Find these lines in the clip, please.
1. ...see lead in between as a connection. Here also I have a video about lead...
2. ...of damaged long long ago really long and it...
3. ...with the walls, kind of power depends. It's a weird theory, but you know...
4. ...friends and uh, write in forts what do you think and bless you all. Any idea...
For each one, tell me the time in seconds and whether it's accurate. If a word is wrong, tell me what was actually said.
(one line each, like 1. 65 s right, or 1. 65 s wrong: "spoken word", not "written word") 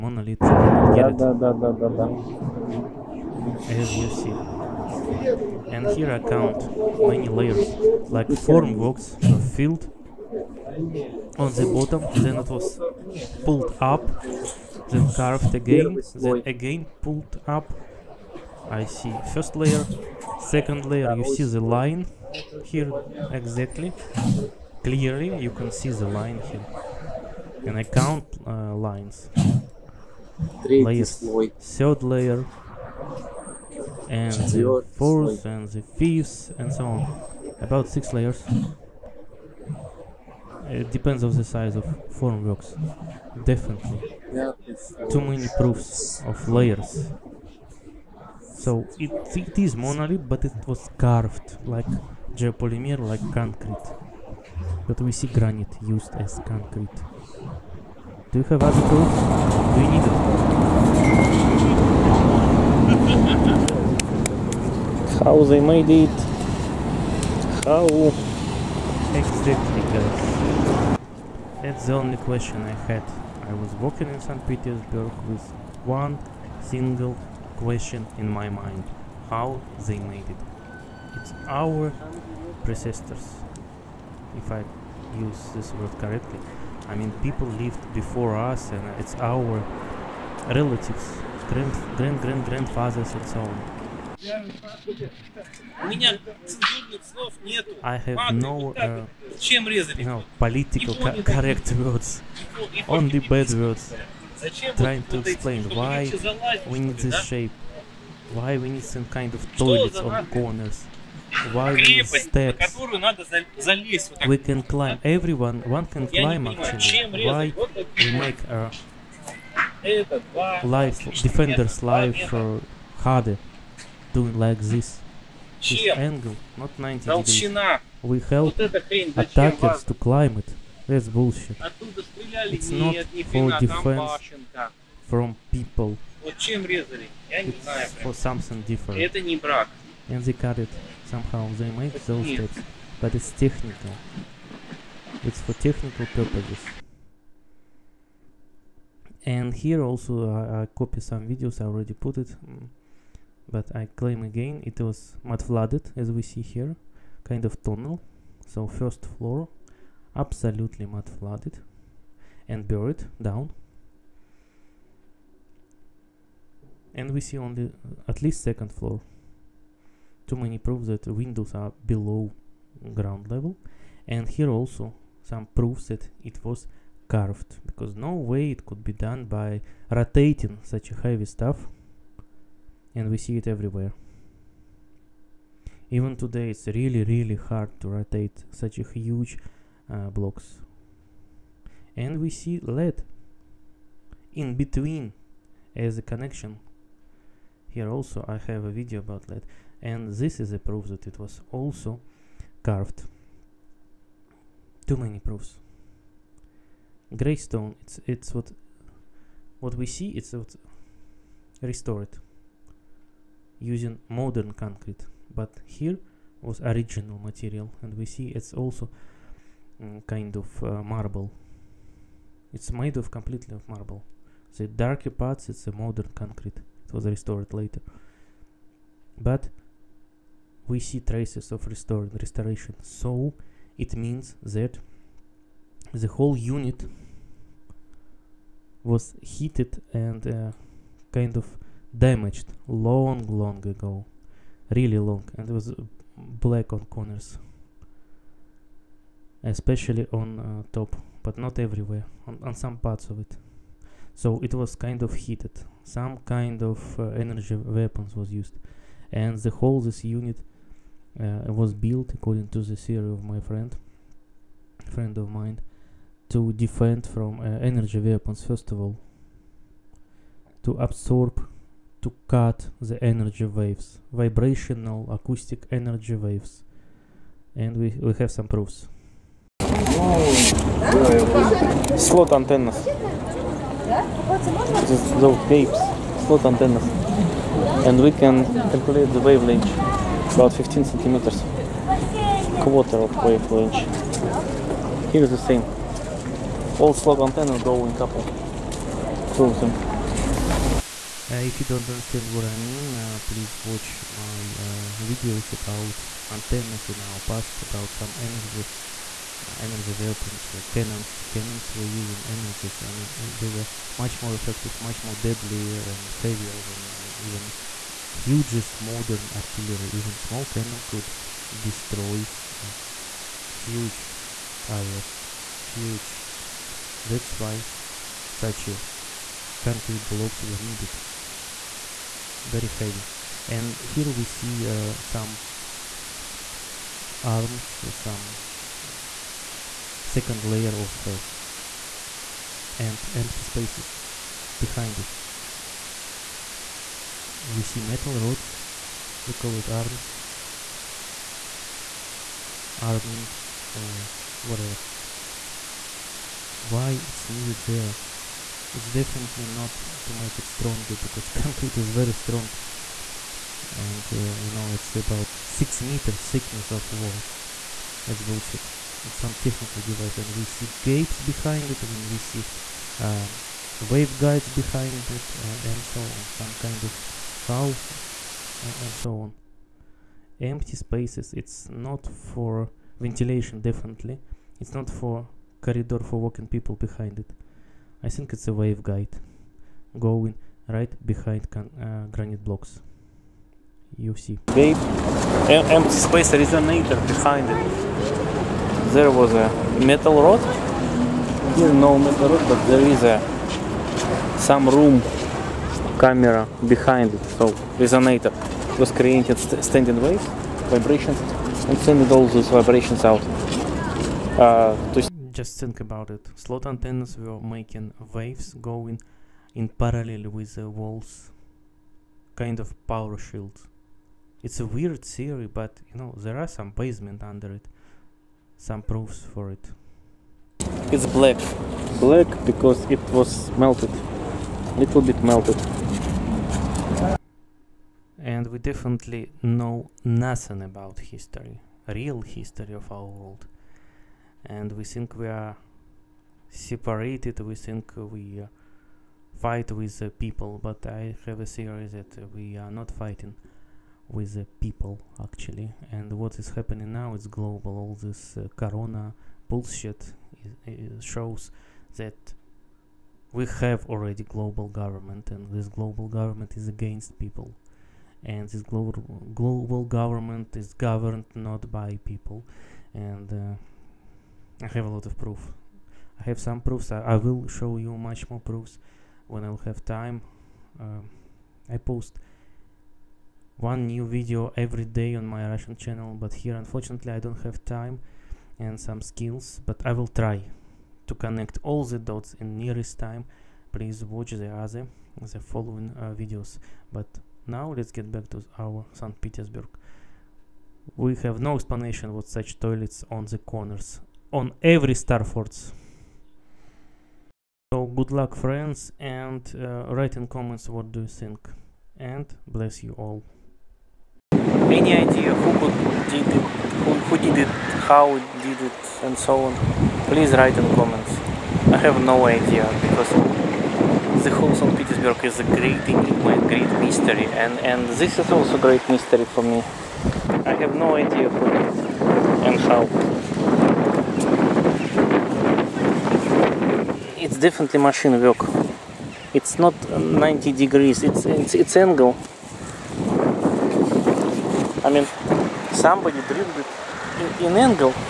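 1. 192 s right
2. 241 s right
3. 420 s wrong: "shields", not "depends"
4. 508 s wrong: "comments", not "forts".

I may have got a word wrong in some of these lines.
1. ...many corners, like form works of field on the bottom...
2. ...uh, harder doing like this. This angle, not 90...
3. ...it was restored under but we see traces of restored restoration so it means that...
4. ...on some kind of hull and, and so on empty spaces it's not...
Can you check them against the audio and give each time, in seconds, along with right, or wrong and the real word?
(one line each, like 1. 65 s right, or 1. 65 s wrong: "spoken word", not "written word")
1. 7 s wrong: "layers", not "corners"
2. 122 s right
3. 226 s wrong: "later", not "under"
4. 376 s right.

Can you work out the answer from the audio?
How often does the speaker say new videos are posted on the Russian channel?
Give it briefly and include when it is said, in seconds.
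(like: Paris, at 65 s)
Every day, at 484 s.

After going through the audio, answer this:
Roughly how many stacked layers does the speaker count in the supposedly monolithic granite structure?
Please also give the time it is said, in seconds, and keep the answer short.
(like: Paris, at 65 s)
6, at 37 s.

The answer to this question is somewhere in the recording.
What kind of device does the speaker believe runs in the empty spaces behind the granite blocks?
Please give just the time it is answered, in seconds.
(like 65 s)
388 s.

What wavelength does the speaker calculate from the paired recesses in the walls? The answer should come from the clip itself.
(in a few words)
15 centimeters.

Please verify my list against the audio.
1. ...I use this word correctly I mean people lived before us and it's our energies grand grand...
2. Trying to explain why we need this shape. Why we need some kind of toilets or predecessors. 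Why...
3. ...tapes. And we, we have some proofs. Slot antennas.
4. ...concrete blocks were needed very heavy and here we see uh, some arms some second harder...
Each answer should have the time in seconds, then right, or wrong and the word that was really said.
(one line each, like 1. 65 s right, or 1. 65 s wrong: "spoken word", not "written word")
1. 84 s wrong: "relatives", not "energies"
2. 104 s wrong: "corners", not "predecessors"
3. 276 s wrong: "waves", not "tapes"
4. 329 s wrong: "layer", not "harder".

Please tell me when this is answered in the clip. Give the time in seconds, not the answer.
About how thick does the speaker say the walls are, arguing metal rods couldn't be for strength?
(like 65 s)
365 s.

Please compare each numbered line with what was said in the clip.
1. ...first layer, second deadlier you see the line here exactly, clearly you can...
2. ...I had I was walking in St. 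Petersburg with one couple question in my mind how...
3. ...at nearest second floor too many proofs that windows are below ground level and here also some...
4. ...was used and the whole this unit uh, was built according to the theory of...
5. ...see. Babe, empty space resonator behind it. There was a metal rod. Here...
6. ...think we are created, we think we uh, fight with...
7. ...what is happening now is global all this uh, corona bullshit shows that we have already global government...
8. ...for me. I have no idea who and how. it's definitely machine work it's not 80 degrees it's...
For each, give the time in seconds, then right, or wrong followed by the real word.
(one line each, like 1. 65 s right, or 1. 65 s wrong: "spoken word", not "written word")
1. 19 s wrong: "layer", not "deadlier"
2. 72 s wrong: "single", not "couple"
3. 168 s wrong: "least", not "nearest"
4. 258 s right
5. 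394 s right
6. 444 s wrong: "separated", not "created"
7. 456 s right
8. 529 s wrong: "90", not "80".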